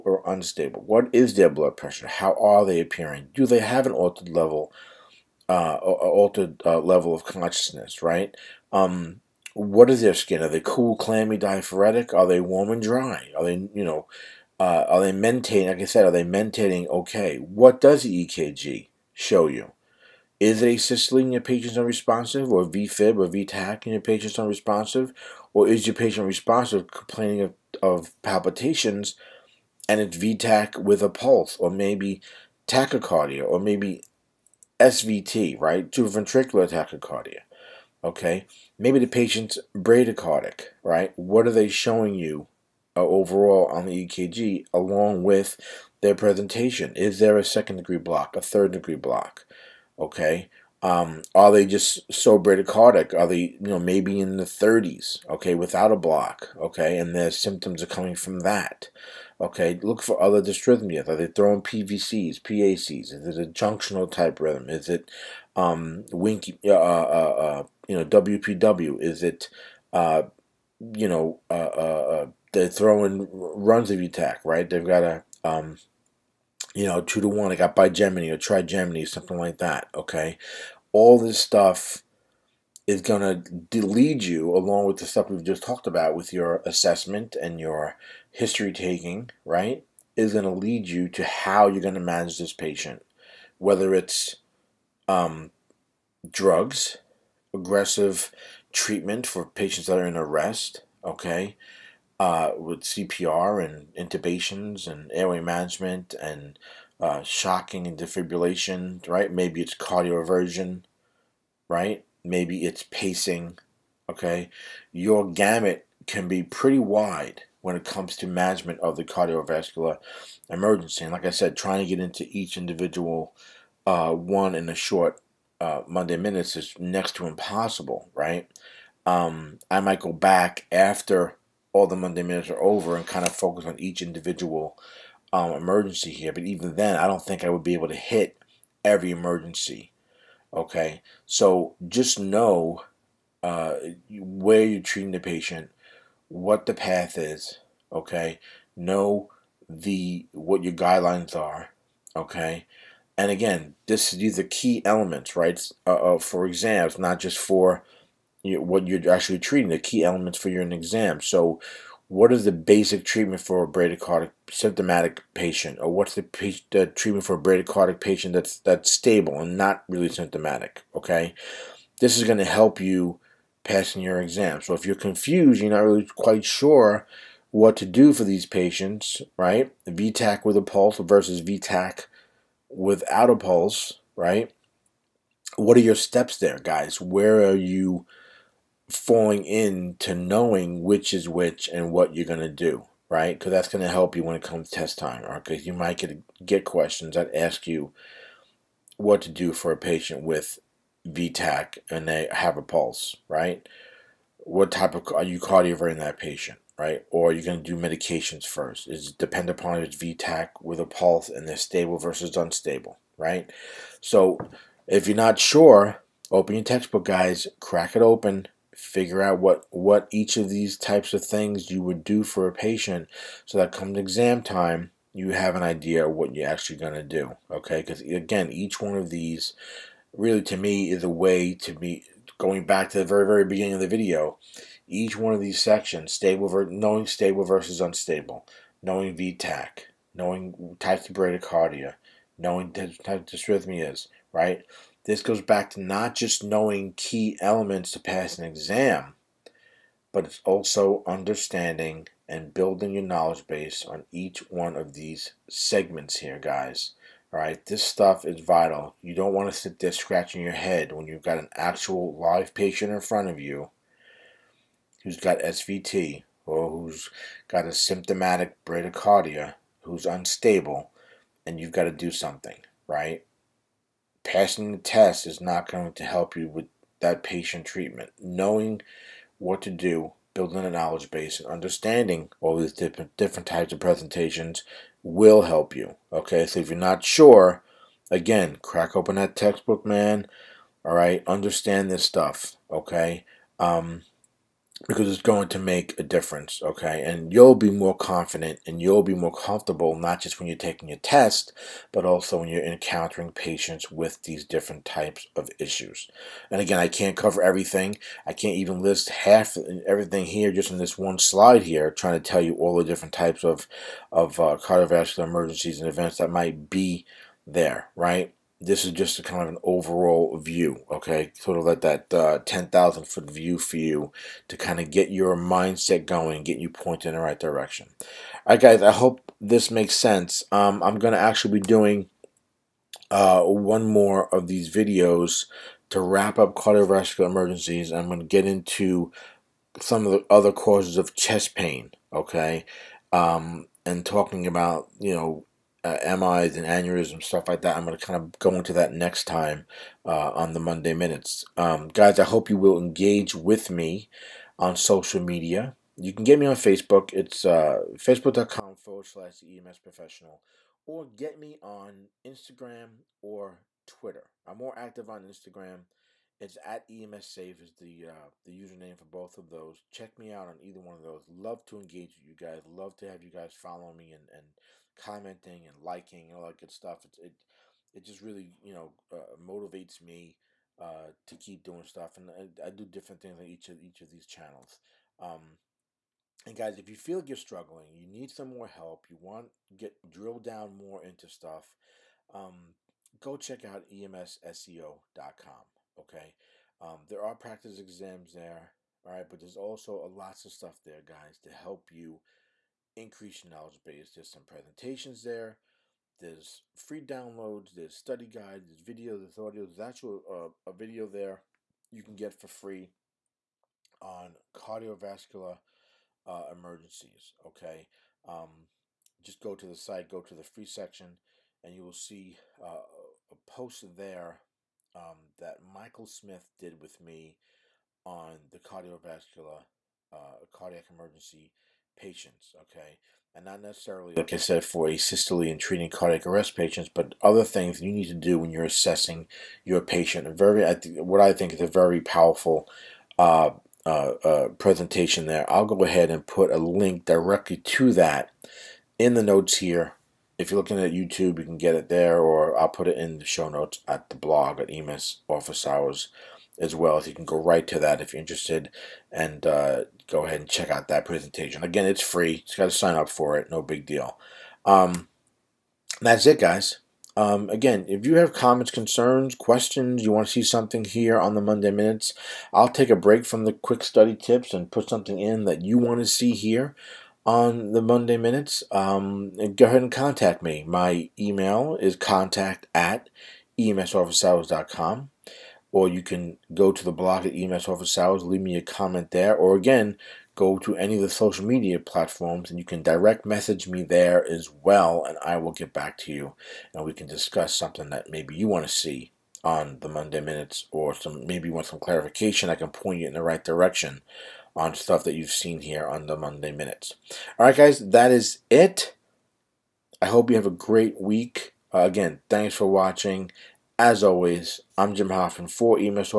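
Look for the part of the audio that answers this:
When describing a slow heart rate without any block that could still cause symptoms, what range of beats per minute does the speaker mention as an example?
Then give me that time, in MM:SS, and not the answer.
00:54.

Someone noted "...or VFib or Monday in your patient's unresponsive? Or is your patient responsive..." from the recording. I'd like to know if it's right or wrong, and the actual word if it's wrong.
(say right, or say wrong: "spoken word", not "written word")
wrong: "VTAC", not "Monday".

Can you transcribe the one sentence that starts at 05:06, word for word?
And again, I can't cover everything.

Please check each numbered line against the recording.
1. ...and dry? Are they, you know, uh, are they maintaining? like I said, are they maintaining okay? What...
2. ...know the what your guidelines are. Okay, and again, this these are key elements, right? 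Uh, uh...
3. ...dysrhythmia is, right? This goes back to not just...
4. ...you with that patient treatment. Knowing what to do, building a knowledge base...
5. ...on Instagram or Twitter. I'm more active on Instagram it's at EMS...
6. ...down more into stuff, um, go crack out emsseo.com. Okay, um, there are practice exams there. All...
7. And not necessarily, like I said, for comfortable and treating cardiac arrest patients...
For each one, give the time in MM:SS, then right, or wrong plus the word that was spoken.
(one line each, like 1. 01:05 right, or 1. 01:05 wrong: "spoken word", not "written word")
1. 00:12 right
2. 02:28 right
3. 04:03 right
4. 04:36 right
5. 06:01 right
6. 06:30 wrong: "check", not "crack"
7. 07:13 wrong: "asystole", not "comfortable".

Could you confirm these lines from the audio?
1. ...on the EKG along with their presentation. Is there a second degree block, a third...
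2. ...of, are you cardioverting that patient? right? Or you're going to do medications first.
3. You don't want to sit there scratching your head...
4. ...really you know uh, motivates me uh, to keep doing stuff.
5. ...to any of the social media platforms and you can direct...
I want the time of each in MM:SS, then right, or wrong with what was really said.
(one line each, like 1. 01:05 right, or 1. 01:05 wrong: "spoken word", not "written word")
1. 00:43 right
2. 03:24 right
3. 04:19 right
4. 06:18 right
5. 08:10 right.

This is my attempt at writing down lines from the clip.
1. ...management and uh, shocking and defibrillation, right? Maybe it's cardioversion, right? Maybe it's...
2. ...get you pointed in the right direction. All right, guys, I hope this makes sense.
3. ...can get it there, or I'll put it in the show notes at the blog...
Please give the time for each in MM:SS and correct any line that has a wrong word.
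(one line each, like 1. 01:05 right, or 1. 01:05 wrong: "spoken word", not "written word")
1. 01:45 right
2. 05:26 right
3. 07:31 right.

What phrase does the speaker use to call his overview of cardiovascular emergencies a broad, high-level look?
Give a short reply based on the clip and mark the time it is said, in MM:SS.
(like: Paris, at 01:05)
10,000 foot view, at 05:22.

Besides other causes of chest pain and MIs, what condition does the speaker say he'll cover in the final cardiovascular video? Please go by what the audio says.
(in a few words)
aneurysms.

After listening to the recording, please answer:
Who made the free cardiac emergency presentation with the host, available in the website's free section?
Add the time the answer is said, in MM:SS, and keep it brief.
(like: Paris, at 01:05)
Michael Smith, at 07:05.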